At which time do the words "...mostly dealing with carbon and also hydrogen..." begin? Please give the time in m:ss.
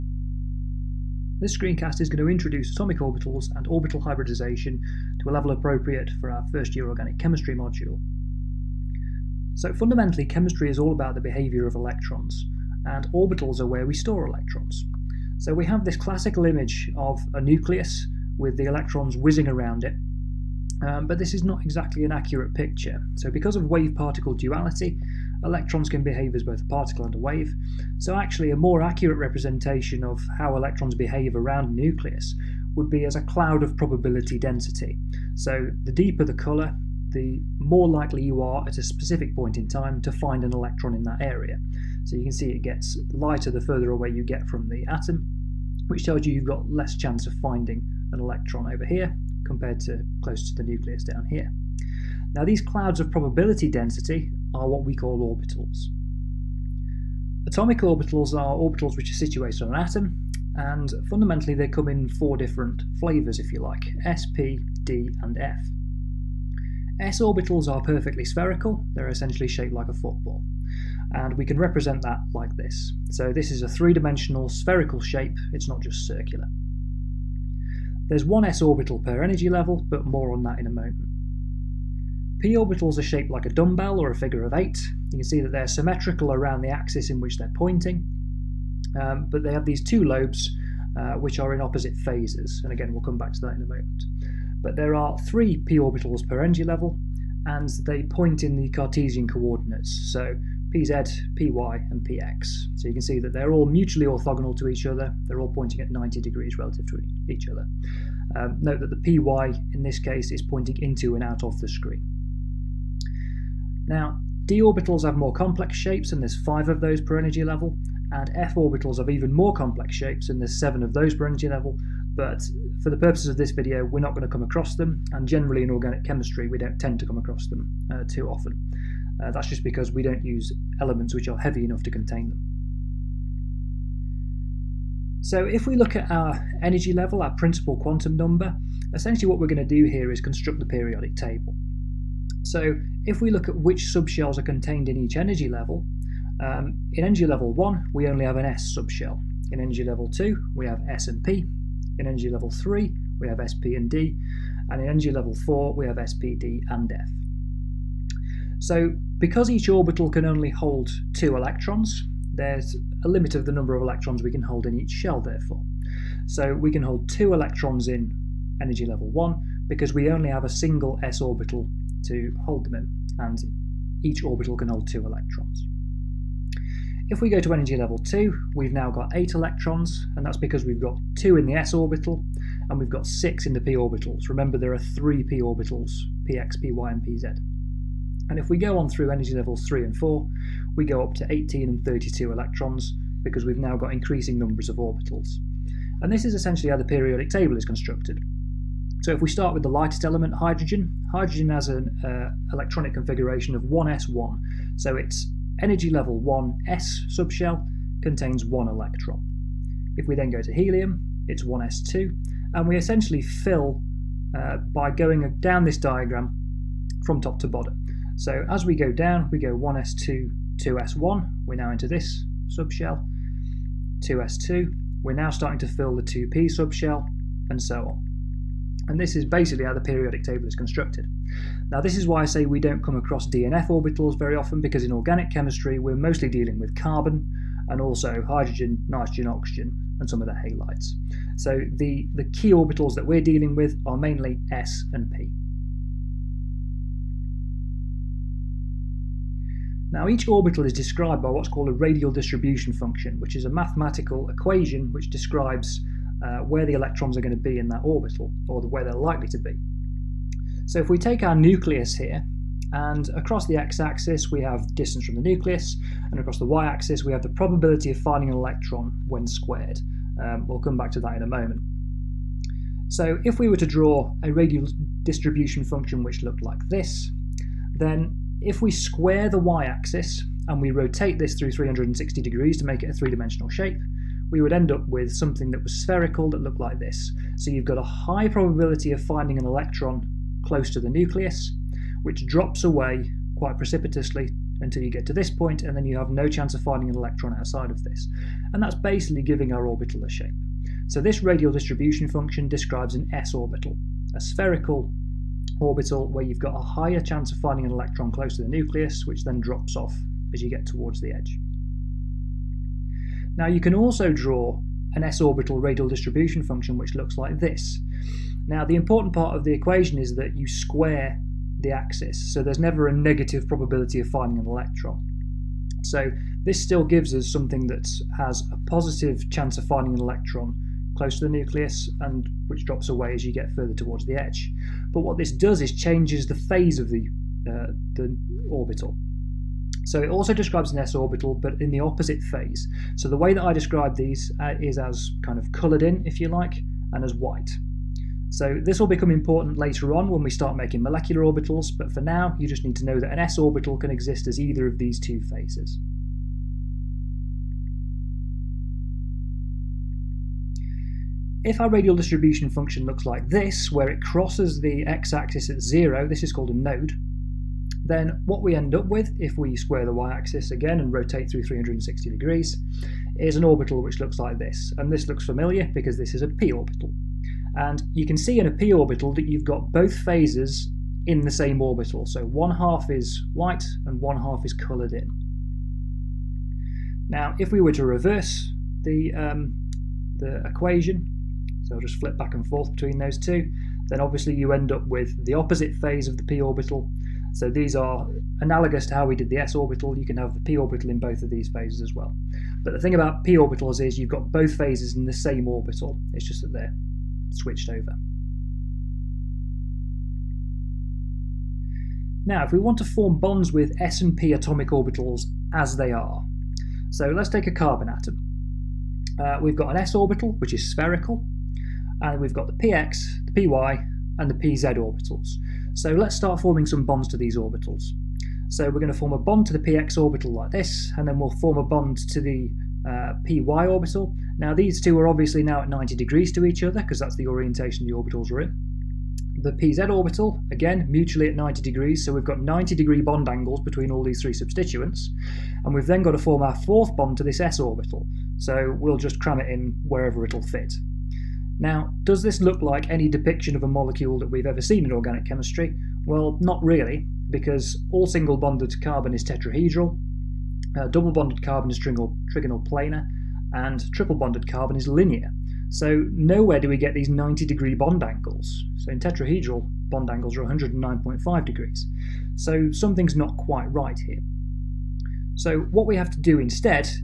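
3:55.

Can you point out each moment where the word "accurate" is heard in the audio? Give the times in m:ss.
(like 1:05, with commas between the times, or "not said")
0:22, 0:28.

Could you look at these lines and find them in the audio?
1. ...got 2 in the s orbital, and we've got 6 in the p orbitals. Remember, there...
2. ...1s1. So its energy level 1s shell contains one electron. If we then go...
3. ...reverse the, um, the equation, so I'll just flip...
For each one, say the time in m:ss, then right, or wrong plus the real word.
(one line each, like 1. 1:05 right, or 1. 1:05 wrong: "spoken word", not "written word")
1. 3:00 right
2. 3:23 wrong: "subshell", not "shell"
3. 6:27 right.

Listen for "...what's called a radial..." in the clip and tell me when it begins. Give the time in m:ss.
4:11.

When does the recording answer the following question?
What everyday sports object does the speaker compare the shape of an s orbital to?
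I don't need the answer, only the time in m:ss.
1:09.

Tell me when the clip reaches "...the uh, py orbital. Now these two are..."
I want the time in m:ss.
7:12.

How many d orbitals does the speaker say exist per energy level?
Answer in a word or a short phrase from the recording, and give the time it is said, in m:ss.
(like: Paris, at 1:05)
5, at 1:56.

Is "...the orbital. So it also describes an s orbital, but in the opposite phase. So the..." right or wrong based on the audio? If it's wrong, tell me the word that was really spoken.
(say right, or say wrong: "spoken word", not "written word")
right.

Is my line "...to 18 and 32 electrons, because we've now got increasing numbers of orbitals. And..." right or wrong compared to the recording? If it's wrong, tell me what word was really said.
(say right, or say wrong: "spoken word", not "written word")
right.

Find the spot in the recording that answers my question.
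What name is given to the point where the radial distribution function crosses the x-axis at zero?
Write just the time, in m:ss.
6:06.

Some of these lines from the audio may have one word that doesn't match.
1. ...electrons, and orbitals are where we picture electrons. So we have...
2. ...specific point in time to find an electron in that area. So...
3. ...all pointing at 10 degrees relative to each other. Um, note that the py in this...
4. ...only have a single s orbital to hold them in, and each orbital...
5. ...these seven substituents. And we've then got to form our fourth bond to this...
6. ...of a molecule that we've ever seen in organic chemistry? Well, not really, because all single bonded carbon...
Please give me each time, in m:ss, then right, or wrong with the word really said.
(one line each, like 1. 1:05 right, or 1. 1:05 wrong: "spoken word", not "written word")
1. 0:11 wrong: "store", not "picture"
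2. 0:38 right
3. 1:45 wrong: "90", not "10"
4. 2:50 right
5. 7:24 wrong: "three", not "seven"
6. 7:33 right.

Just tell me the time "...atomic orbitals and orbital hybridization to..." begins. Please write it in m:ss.
0:02.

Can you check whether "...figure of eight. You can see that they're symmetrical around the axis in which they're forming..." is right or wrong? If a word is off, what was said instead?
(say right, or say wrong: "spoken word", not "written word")
wrong: "pointing", not "forming".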